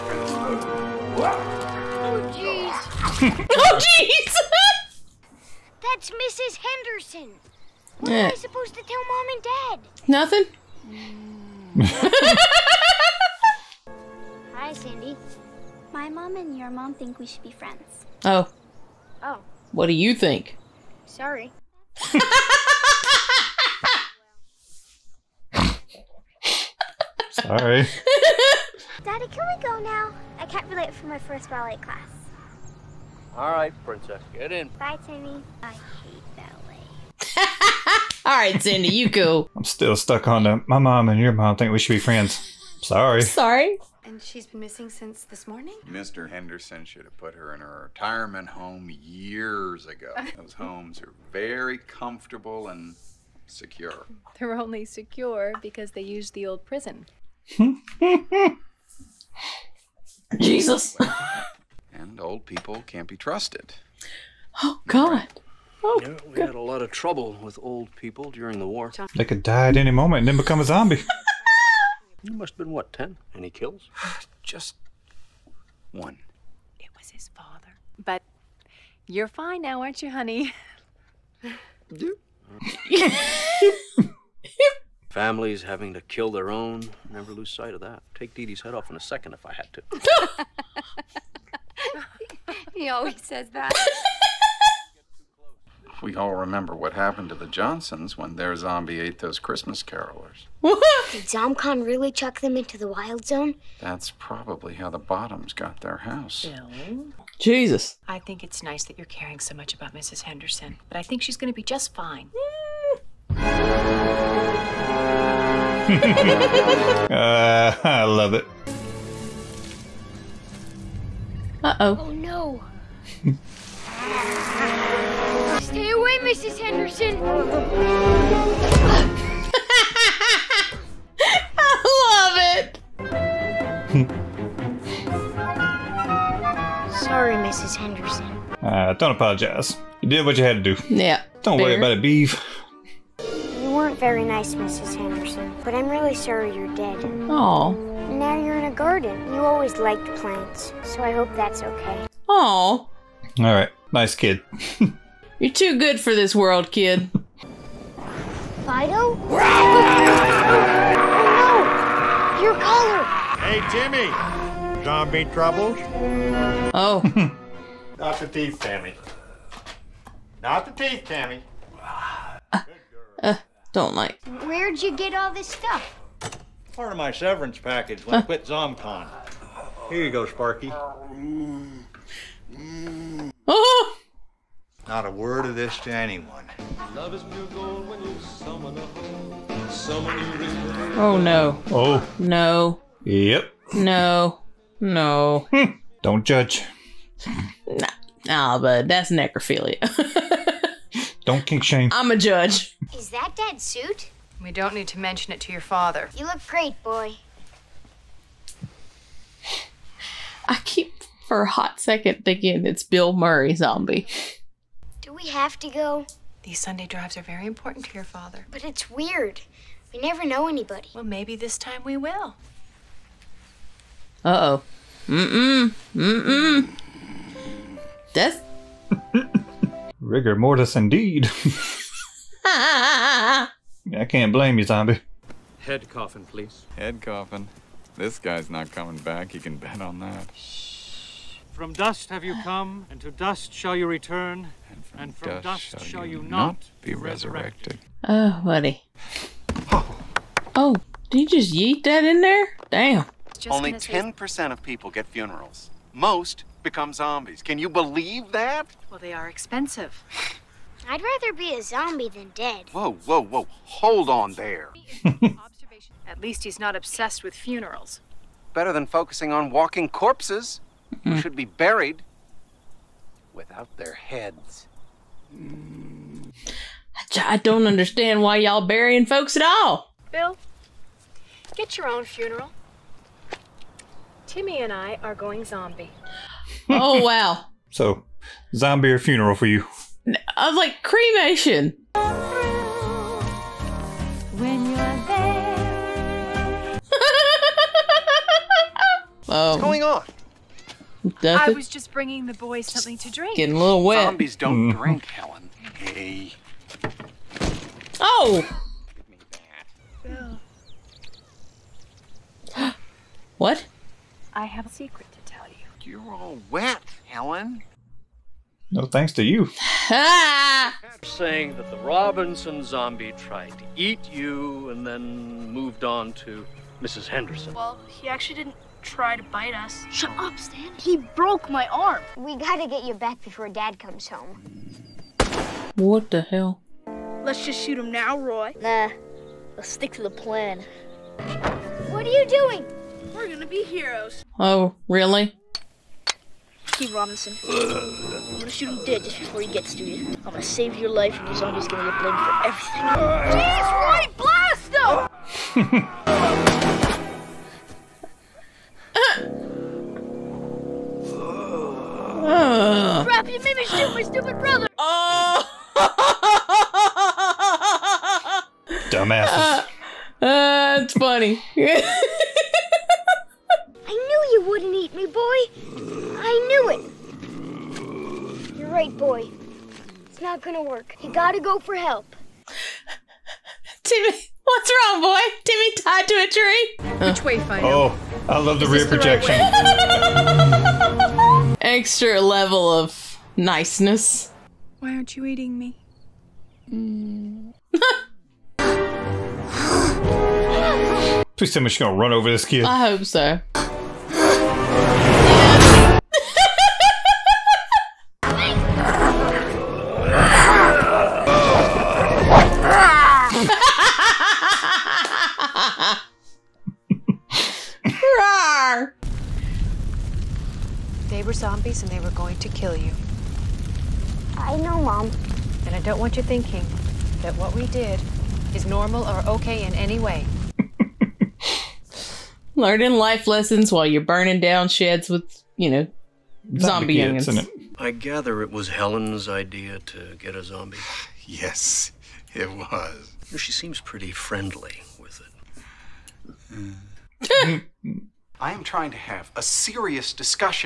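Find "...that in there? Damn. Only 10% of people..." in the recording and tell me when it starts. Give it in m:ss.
4:11.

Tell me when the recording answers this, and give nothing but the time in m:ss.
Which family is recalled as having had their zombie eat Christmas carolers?
1:37.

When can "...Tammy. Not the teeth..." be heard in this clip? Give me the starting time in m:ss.
2:48.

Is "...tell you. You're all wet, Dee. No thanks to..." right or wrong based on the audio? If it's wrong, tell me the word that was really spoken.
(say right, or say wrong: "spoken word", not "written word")
wrong: "Helen", not "Dee".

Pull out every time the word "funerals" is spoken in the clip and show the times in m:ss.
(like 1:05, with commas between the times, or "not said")
4:15, 4:27, 4:42, 4:48.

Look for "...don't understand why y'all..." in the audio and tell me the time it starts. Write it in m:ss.
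4:37.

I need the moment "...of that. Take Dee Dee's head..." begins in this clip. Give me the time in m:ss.
1:27.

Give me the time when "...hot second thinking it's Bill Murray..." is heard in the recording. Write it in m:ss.
3:31.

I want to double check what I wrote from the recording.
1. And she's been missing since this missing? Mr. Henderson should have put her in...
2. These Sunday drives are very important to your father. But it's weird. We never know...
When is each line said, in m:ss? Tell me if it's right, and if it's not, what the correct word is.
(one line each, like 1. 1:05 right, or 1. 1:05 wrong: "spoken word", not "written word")
1. 0:44 wrong: "morning", not "missing"
2. 3:36 right.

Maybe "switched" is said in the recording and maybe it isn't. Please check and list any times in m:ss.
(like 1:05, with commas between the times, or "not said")
not said.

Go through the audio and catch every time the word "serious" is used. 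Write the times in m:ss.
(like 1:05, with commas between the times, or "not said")
7:29.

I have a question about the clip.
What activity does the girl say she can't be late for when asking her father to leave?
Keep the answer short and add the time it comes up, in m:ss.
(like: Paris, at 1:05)
First ballet class, at 0:31.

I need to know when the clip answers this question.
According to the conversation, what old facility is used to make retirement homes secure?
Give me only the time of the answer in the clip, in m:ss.
0:56.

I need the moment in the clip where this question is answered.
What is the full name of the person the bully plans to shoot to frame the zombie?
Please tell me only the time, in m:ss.
5:46.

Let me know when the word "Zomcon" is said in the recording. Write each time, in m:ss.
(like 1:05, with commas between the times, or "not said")
1:41, 2:58.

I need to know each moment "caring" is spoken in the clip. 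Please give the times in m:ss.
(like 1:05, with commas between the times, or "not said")
1:49.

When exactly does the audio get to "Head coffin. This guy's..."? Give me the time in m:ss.
3:56.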